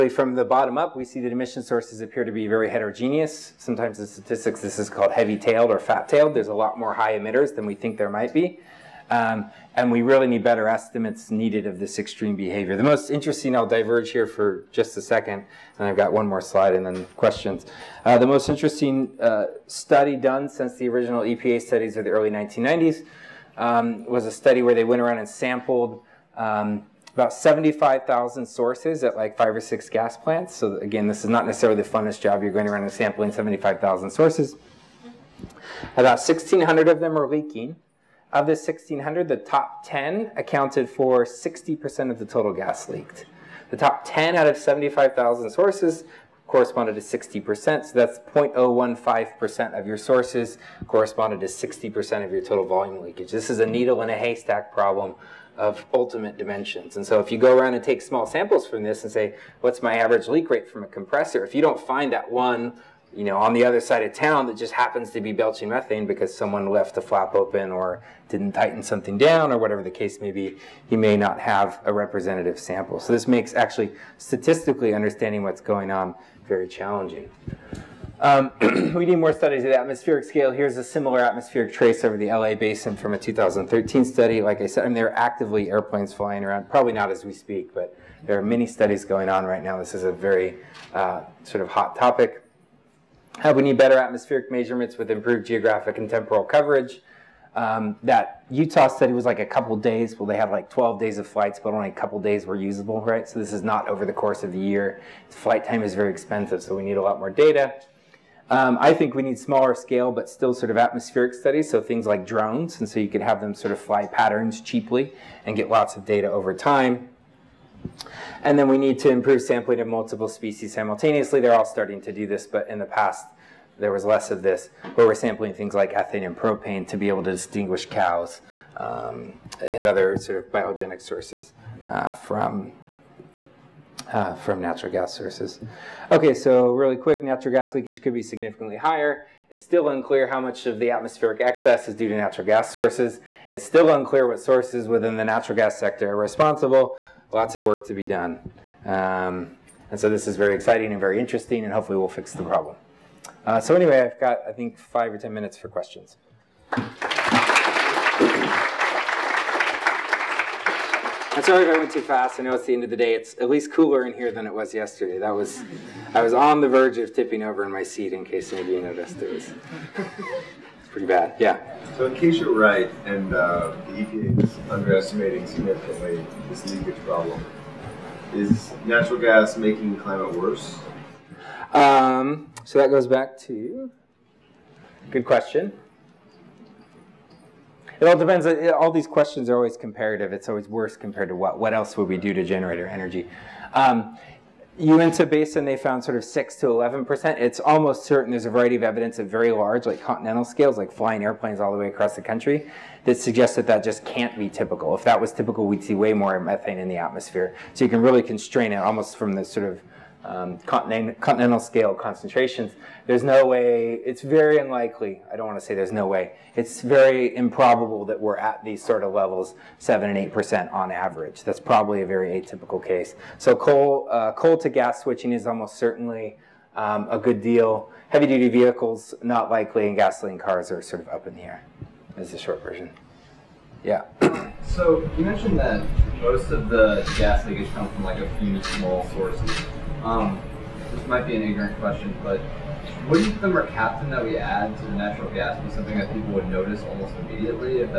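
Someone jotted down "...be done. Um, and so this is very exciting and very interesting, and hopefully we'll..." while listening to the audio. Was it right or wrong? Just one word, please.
right.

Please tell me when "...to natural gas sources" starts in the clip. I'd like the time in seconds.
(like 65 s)
142 s.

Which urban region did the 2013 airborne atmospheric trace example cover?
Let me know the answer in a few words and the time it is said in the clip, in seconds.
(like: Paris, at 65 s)
LA basin, at 82 s.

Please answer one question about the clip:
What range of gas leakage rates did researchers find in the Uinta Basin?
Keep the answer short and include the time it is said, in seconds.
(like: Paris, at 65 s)
6 to 11%, at 196 s.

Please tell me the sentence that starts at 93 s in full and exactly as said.
How we need better atmospheric measurements with improved geographic and temporal coverage.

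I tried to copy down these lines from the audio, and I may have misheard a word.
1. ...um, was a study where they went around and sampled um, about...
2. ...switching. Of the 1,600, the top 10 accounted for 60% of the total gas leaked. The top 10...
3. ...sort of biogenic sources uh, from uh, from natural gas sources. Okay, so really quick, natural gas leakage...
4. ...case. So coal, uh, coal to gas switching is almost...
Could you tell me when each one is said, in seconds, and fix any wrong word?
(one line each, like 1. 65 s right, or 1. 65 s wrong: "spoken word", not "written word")
1. 23 s right
2. 37 s wrong: "leaking", not "switching"
3. 130 s right
4. 222 s right.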